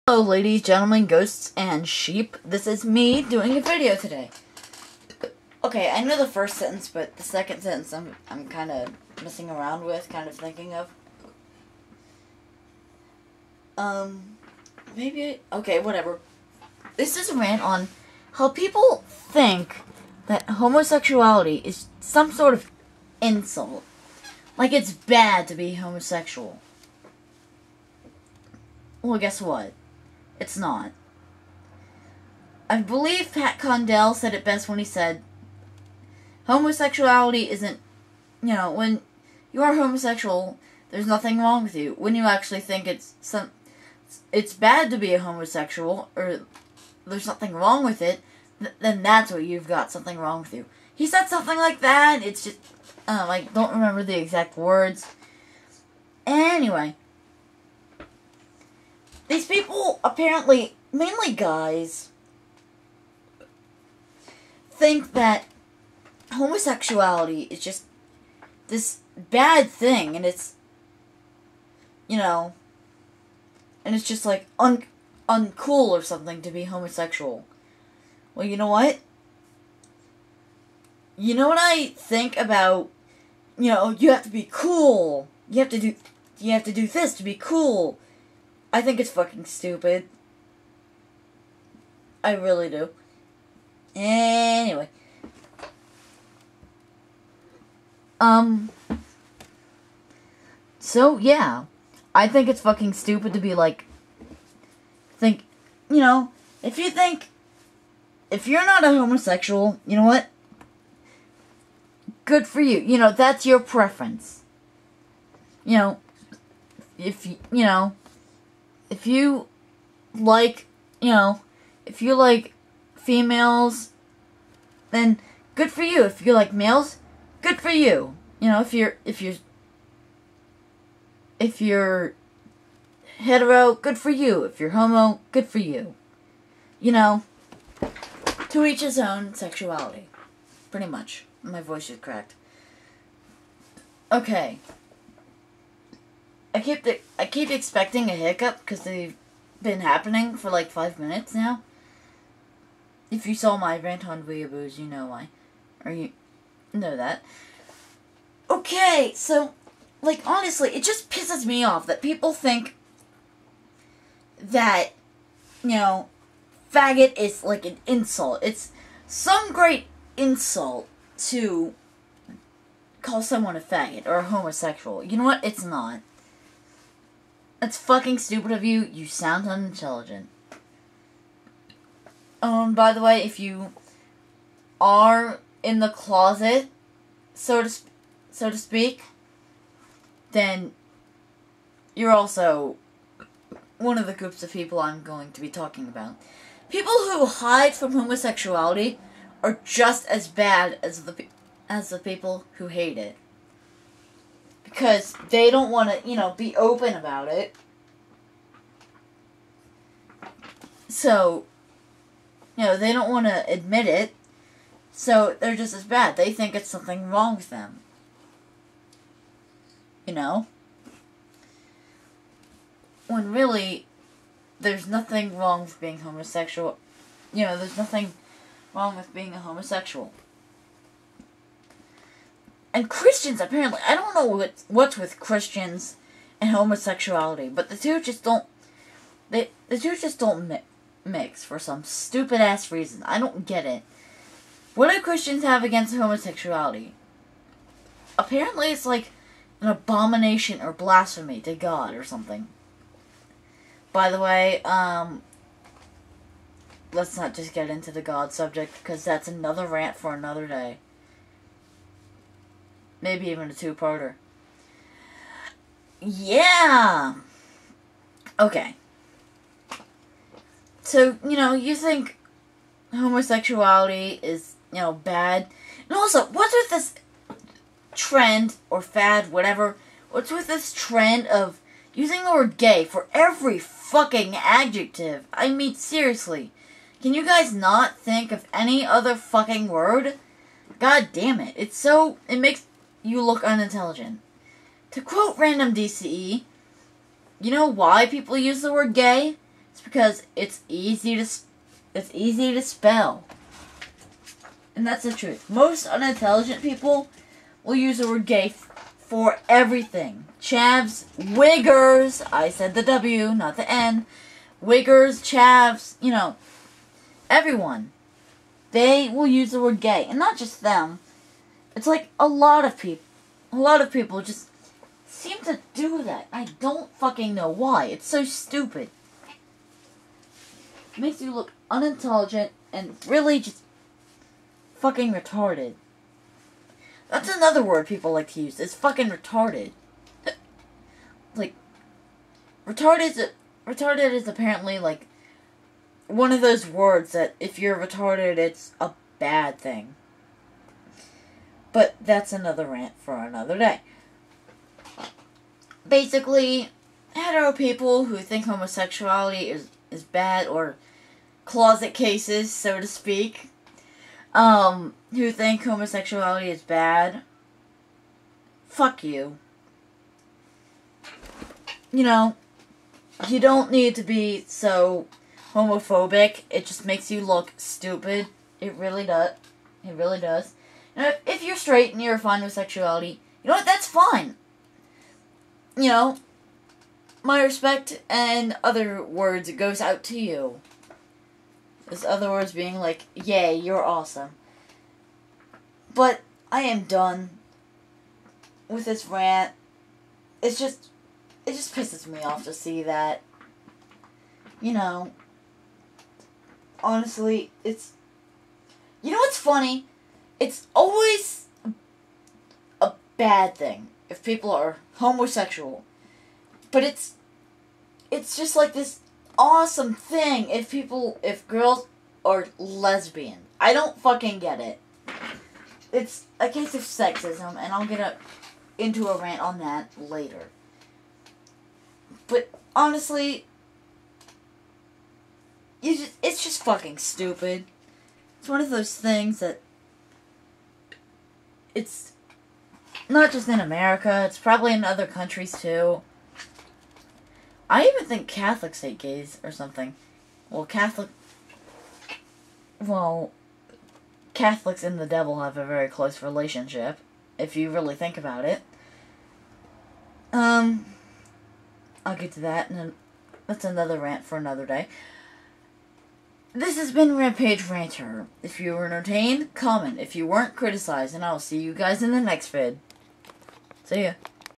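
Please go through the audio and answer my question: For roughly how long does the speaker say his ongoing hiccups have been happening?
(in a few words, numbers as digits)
5 minutes.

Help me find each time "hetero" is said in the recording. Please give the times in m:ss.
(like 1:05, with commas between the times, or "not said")
2:13, 5:57.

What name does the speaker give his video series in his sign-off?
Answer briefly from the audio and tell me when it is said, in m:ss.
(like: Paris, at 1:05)
Rampage Rants, at 7:47.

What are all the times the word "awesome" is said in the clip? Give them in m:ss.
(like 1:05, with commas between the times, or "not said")
6:33, 6:59.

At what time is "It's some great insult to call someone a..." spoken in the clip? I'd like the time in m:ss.
2:48.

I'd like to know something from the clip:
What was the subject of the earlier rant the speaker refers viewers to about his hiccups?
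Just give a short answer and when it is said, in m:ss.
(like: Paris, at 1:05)
Weeaboos, at 2:34.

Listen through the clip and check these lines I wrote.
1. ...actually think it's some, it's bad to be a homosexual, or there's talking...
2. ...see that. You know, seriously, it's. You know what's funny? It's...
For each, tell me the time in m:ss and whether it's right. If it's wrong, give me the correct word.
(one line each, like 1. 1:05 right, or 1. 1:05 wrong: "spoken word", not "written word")
1. 0:42 wrong: "nothing", not "talking"
2. 6:42 wrong: "honestly", not "seriously".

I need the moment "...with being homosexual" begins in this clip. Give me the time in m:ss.
3:45.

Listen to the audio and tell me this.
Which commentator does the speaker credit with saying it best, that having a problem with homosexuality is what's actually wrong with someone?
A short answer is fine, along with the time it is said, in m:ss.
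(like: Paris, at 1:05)
Pat Condell, at 0:33.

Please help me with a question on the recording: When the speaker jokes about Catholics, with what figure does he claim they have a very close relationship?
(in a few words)
the devil.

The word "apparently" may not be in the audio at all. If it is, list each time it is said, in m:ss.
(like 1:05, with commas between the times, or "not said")
1:00, 3:53, 4:08, 5:44.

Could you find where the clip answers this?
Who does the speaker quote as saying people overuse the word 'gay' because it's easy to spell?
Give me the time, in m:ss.
4:55.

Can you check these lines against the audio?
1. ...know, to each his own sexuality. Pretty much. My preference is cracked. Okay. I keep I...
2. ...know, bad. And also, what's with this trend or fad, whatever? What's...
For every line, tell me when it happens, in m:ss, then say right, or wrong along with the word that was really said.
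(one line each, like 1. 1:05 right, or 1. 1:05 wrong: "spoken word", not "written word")
1. 2:16 wrong: "voice", not "preference"
2. 4:34 right.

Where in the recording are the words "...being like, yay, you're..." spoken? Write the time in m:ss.
6:32.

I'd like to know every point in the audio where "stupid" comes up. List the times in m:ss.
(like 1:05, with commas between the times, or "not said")
1:29, 1:42, 2:58, 4:01, 5:28, 6:17, 7:16.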